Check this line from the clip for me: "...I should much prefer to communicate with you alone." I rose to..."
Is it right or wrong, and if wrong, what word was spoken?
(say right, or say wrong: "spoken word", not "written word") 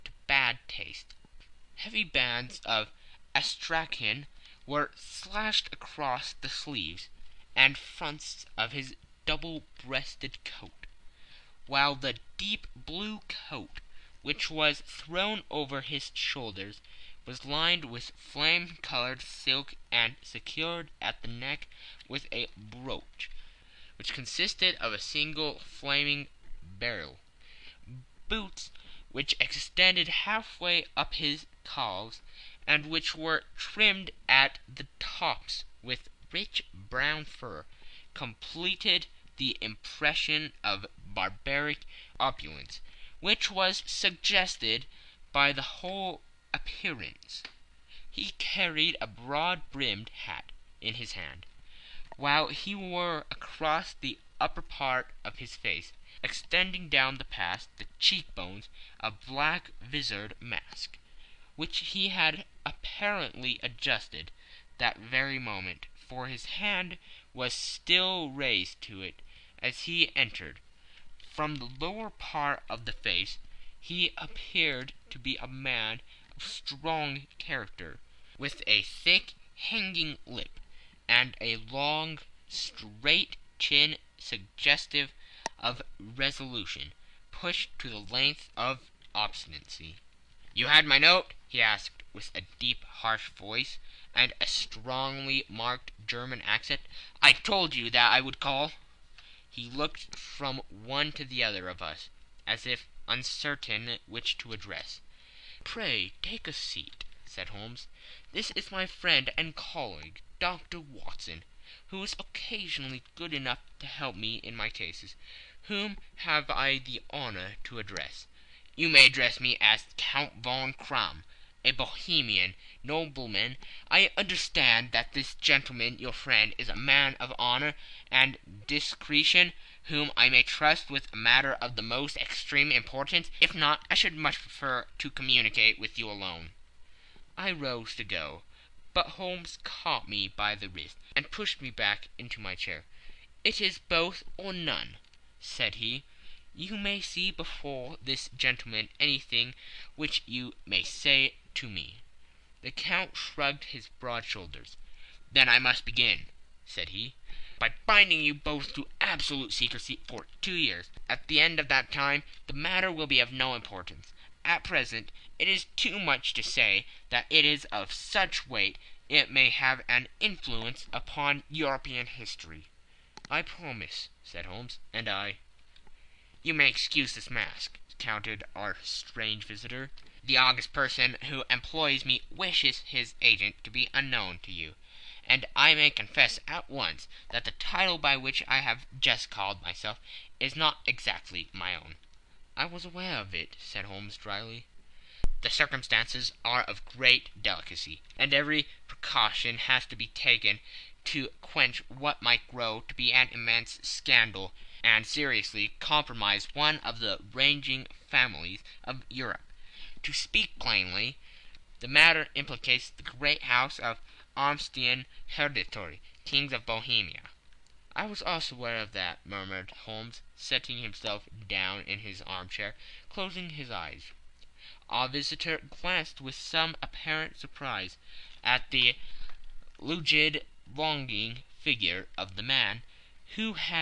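right.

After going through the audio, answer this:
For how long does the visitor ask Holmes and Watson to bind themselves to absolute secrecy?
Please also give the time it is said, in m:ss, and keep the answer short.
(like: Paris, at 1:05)
2 years, at 2:40.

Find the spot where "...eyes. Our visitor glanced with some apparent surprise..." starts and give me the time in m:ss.
3:43.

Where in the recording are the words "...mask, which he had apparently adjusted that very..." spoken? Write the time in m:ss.
1:00.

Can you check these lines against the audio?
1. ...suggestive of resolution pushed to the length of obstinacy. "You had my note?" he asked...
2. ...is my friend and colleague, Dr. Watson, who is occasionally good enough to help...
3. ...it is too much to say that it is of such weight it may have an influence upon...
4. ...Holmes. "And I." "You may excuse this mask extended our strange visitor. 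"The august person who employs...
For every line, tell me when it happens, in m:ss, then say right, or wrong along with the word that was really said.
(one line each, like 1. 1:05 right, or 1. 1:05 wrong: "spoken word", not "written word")
1. 1:24 right
2. 1:48 right
3. 2:45 right
4. 2:54 wrong: "countered", not "extended".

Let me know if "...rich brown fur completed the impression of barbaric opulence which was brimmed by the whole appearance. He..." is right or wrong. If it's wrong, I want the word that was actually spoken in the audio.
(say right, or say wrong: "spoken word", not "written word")
wrong: "suggested", not "brimmed".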